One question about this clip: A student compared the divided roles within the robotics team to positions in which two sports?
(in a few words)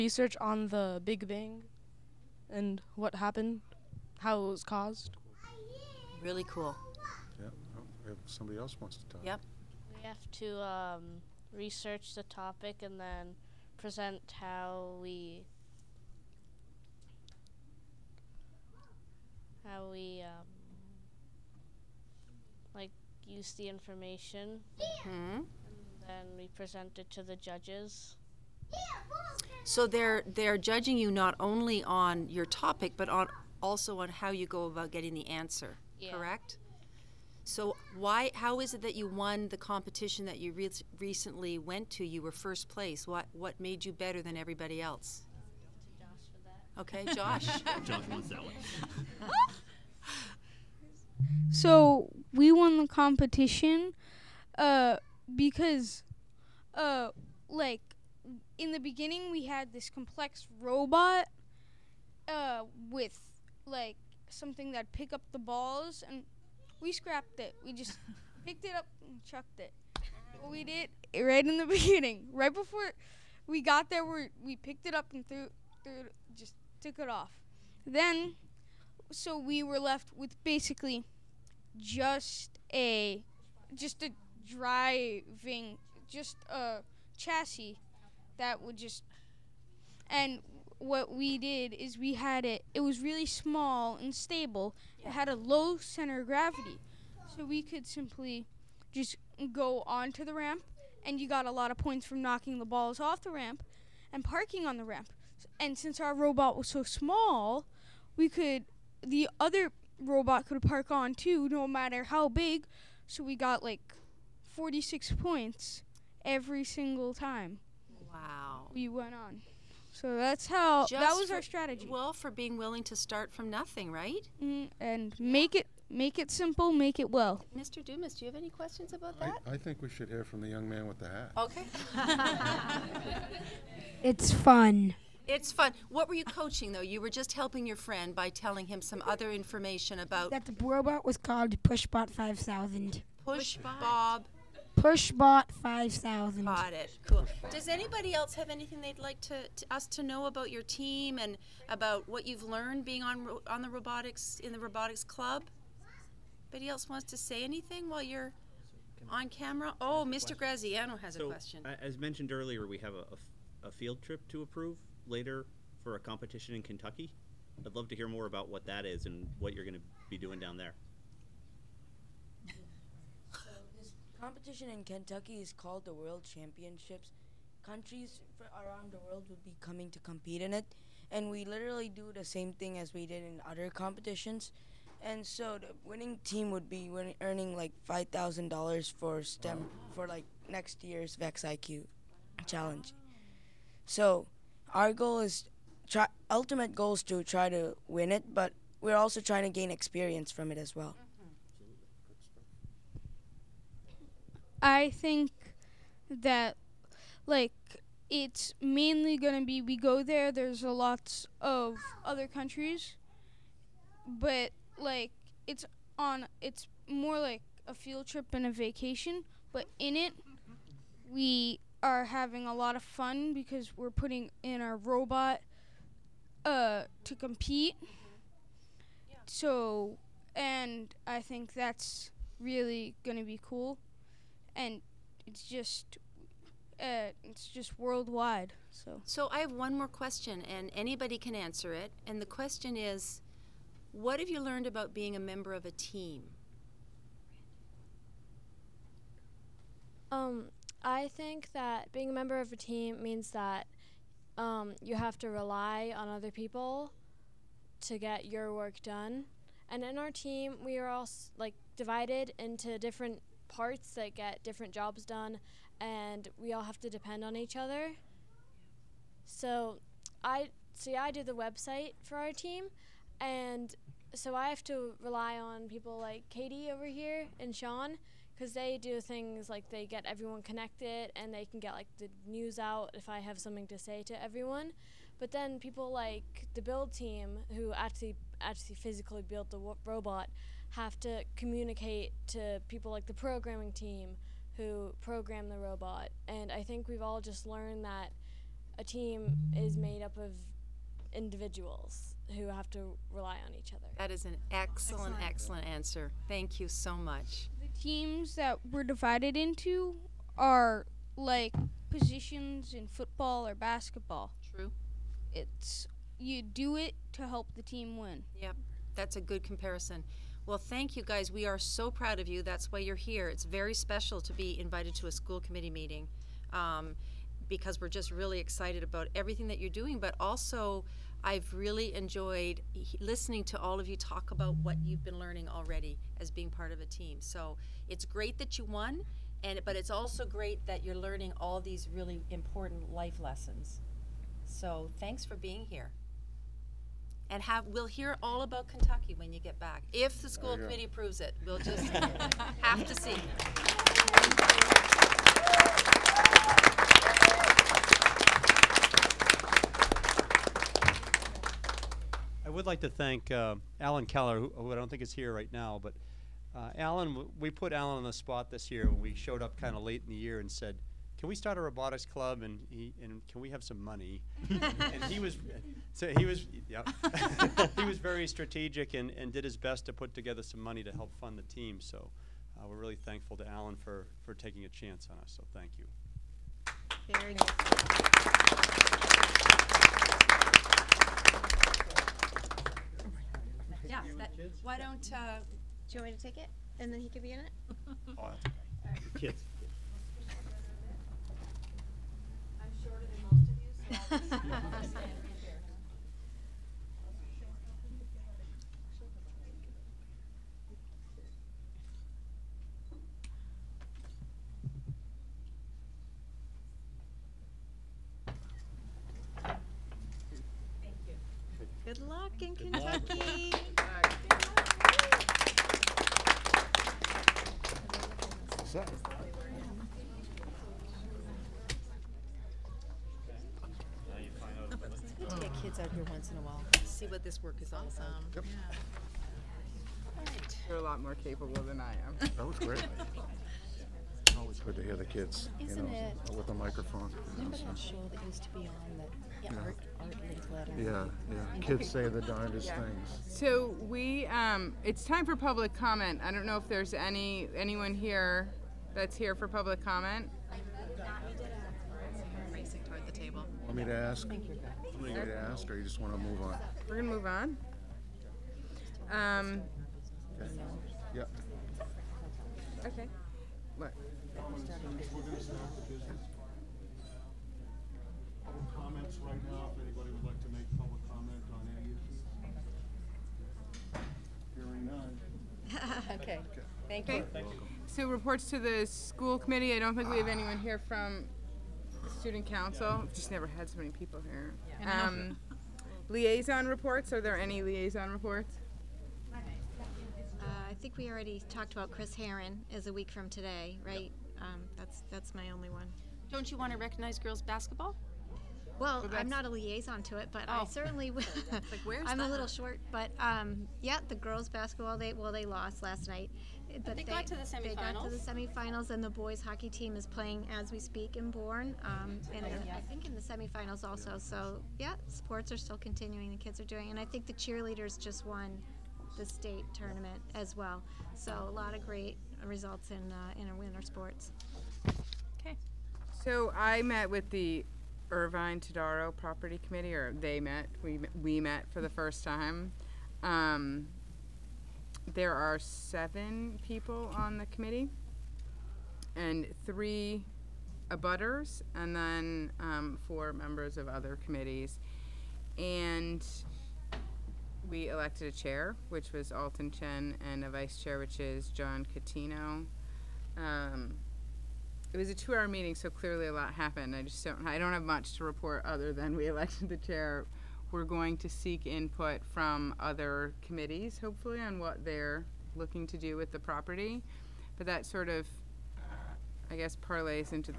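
Football or basketball.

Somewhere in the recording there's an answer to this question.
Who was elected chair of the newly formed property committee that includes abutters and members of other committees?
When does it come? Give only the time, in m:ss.
9:19.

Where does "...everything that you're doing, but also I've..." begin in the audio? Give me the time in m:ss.
5:29.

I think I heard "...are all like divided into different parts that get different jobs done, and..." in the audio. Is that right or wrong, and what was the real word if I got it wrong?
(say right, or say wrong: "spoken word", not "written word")
right.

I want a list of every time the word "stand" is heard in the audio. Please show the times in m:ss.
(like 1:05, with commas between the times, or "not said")
6:44.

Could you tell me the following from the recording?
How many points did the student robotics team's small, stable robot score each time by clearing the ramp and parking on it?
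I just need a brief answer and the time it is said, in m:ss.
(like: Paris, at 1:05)
46, at 1:54.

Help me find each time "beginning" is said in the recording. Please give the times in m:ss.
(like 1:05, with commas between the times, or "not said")
0:58, 1:11.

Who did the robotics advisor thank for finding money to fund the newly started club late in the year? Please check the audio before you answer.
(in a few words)
Alan Keller.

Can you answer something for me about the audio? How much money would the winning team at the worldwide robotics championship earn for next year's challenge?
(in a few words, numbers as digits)
$5,000.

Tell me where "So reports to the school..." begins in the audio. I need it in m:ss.
8:07.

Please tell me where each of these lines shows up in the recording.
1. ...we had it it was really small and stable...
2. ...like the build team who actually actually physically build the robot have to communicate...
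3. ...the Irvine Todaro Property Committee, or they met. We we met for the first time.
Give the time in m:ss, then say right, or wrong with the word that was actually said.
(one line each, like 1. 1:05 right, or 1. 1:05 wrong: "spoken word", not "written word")
1. 1:31 right
2. 4:45 right
3. 8:57 right.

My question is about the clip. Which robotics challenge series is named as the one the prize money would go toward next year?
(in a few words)
Vex IQ.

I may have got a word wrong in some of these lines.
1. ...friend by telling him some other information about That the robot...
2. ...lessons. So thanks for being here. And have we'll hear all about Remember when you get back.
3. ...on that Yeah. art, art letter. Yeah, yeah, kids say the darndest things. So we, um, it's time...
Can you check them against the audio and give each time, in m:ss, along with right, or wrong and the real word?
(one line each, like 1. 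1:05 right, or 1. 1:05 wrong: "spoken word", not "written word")
1. 2:17 right
2. 5:43 wrong: "Kentucky", not "Remember"
3. 7:28 right.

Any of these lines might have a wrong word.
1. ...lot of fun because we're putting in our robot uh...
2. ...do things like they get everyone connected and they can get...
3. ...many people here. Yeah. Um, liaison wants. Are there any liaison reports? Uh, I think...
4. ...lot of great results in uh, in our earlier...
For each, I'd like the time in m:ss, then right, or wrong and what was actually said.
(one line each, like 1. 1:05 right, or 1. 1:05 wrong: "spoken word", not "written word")
1. 3:42 right
2. 4:38 right
3. 8:13 wrong: "reports", not "wants"
4. 8:51 wrong: "winter", not "earlier".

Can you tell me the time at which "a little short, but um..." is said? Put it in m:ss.
8:32.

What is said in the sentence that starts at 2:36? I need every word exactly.
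Anybody else wants to say anything while you're on camera?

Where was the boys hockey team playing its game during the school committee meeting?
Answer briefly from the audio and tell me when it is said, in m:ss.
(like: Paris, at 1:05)
Bourne, at 8:41.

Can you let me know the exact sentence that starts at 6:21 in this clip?
So uh, we're really thankful to Alan for for taking a chance on us.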